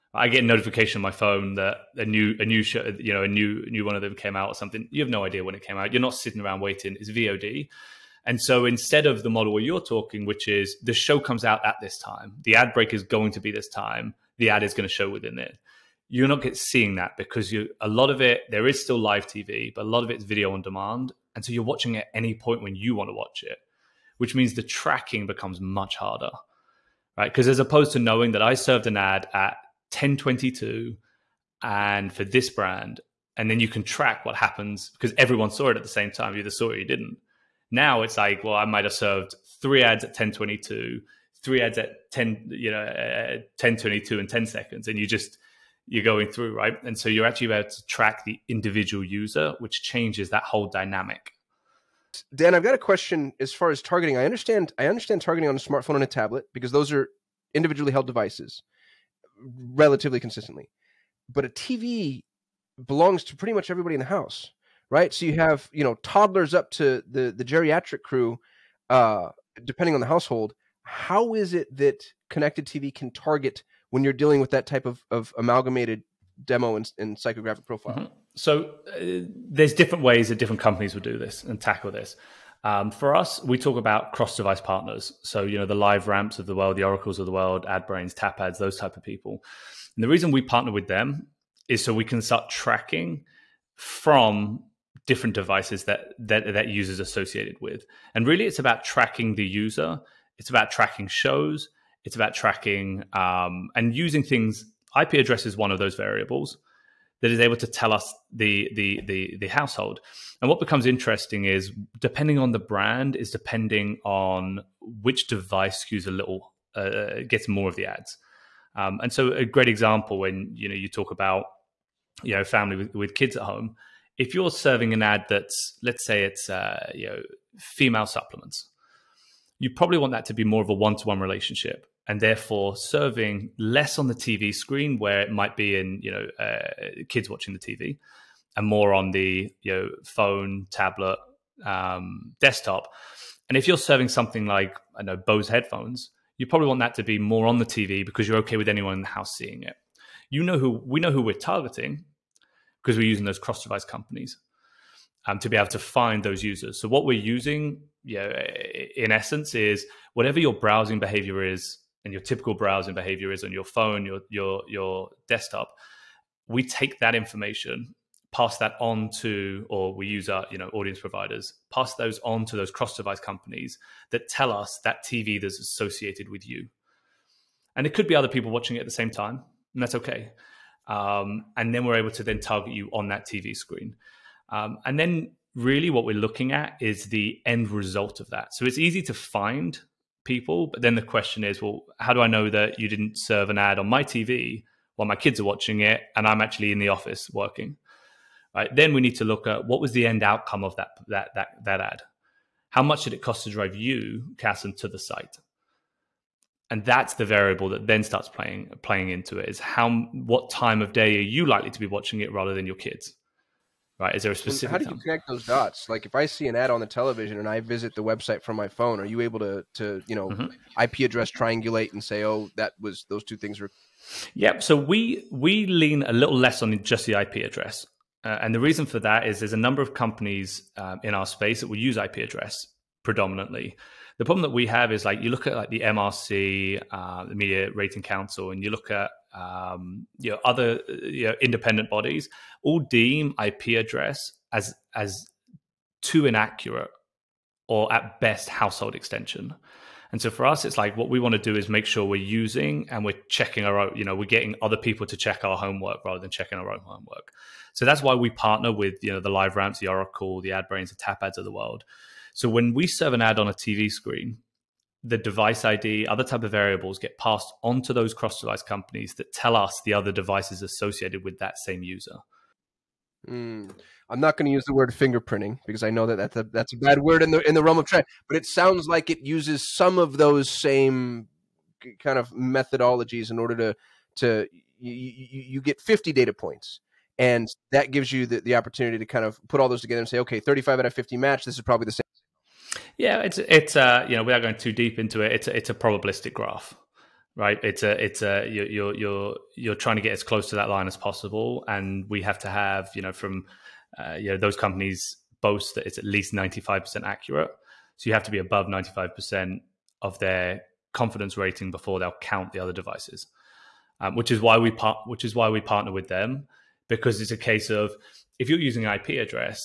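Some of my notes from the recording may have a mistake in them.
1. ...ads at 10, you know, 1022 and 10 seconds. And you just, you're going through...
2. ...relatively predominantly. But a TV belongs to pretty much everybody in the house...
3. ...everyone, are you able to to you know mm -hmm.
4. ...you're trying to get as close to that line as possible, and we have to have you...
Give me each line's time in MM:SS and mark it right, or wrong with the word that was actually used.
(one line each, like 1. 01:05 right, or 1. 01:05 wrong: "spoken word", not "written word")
1. 00:41 right
2. 00:59 wrong: "consistently", not "predominantly"
3. 03:38 wrong: "phone", not "everyone"
4. 04:59 right.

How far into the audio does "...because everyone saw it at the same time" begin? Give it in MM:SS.
00:34.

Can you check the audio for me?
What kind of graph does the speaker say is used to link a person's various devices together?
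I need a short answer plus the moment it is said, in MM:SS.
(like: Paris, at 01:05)
Probabilistic graph, at 04:55.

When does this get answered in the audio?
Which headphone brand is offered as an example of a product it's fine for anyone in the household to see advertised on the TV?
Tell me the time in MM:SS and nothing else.
02:25.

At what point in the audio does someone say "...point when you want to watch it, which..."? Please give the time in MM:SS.
00:22.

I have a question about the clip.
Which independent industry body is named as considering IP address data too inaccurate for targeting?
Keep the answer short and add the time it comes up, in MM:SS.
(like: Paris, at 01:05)
Media Rating Council, at 03:57.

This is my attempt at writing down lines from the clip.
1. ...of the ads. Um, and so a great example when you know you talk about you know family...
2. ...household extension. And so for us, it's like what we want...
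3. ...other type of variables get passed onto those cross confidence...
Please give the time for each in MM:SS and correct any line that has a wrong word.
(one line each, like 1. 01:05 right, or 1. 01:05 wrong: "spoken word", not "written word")
1. 01:57 right
2. 04:08 right
3. 04:26 wrong: "device", not "confidence".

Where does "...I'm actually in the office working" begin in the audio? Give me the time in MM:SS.
03:16.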